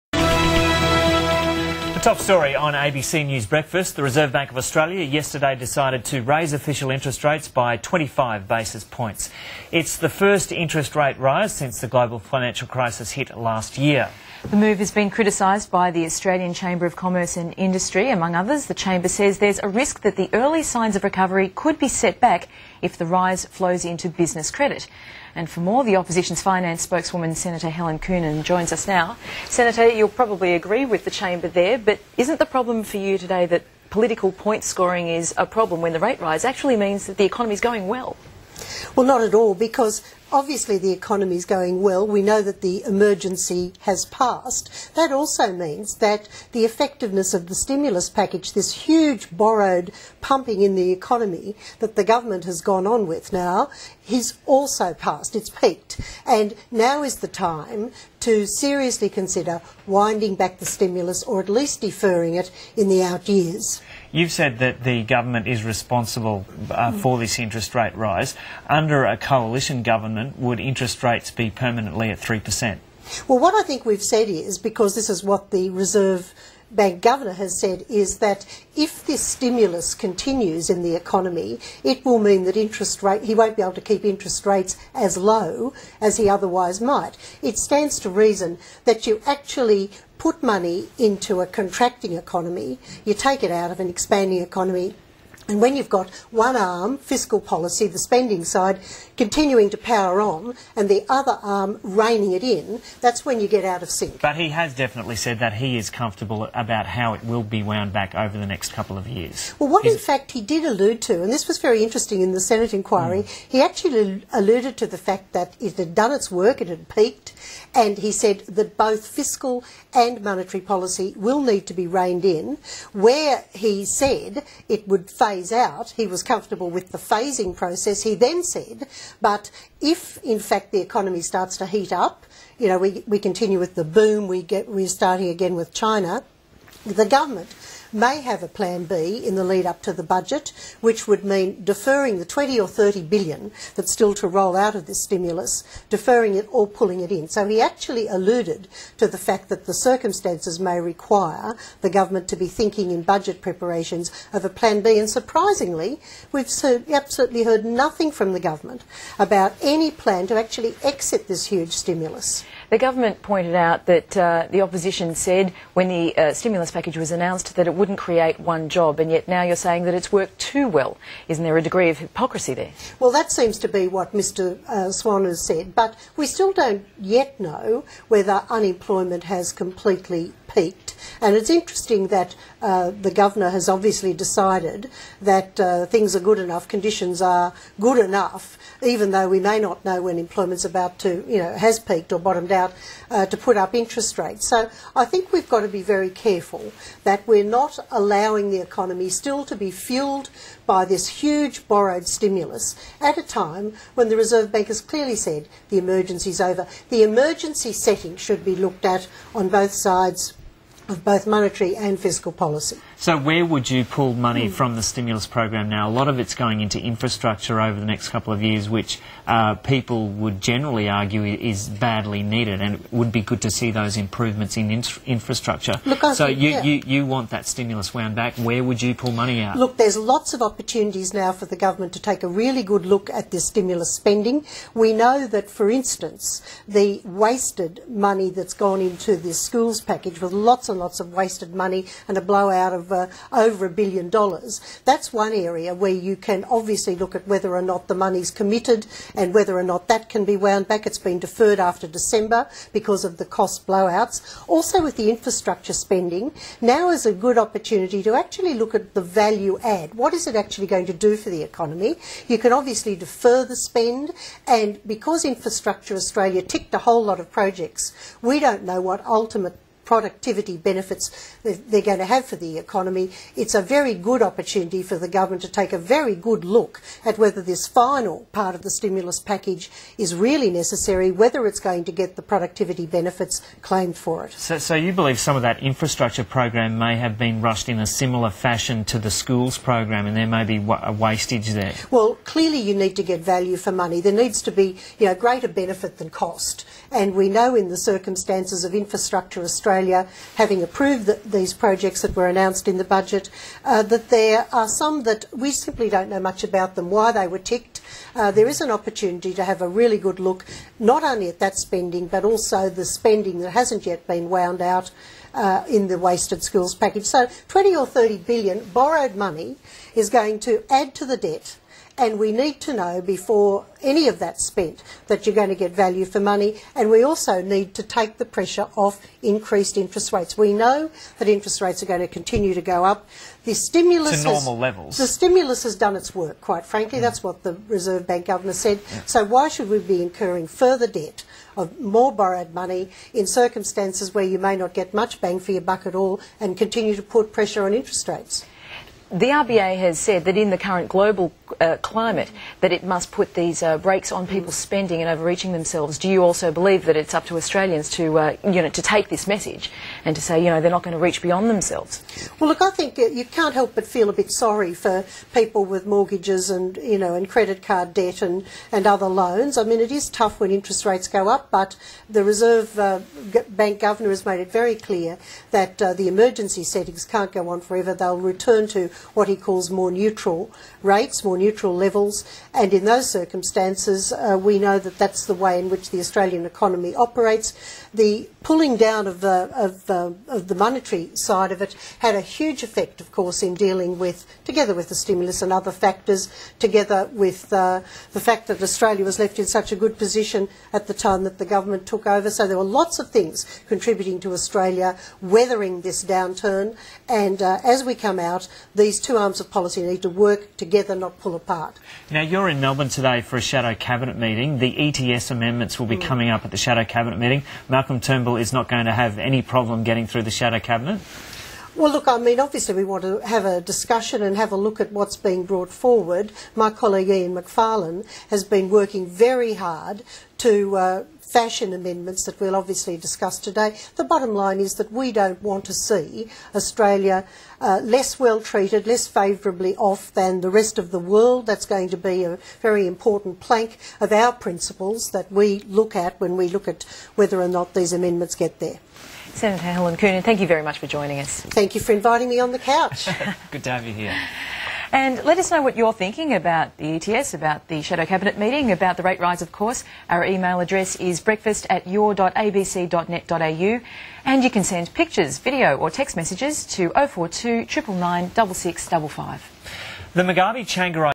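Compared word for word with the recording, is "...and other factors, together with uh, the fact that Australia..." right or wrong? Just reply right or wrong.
right.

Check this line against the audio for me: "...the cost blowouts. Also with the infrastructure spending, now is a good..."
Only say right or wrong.
right.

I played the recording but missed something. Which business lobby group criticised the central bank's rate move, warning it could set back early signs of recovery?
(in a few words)
Australian Chamber of Commerce and Industry.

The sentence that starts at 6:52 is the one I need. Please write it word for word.
Now, you're in Melbourne today for a Shadow Cabinet meeting.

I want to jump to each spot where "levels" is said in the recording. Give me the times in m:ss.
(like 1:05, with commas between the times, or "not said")
5:34, 6:21.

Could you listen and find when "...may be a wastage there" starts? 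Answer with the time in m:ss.
4:50.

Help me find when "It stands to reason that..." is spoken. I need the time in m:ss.
1:27.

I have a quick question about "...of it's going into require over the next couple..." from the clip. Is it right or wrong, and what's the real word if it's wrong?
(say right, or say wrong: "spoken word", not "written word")
wrong: "infrastructure", not "require".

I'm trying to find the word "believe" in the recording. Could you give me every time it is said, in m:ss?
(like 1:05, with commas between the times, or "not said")
4:44, 5:56.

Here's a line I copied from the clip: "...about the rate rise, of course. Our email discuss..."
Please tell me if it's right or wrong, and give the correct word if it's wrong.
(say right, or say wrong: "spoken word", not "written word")
wrong: "address", not "discuss".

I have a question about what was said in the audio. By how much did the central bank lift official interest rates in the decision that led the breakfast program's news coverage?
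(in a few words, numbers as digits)
25 basis points.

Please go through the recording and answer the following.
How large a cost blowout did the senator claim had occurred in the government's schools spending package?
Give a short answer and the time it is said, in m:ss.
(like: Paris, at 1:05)
Over a billion dollars, at 4:03.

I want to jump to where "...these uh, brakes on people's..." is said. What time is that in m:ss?
5:53.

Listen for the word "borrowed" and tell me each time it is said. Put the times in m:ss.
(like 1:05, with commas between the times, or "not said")
0:49, 3:21, 5:18, 5:42.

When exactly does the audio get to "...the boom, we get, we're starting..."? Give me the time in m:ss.
2:13.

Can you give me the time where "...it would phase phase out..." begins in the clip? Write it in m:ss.
2:04.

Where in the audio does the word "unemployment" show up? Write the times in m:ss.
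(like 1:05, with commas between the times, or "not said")
2:58.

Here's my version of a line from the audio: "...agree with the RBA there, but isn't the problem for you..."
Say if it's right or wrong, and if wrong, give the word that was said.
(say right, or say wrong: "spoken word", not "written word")
wrong: "Chamber", not "RBA".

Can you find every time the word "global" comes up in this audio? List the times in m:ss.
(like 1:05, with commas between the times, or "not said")
0:11, 5:50.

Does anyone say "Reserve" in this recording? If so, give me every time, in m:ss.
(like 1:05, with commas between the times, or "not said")
0:04, 1:15, 3:24, 5:37, 6:12.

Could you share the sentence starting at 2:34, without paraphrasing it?
And surprisingly, we've absolutely heard nothing from the government about any plan to actually exit this huge stimulus.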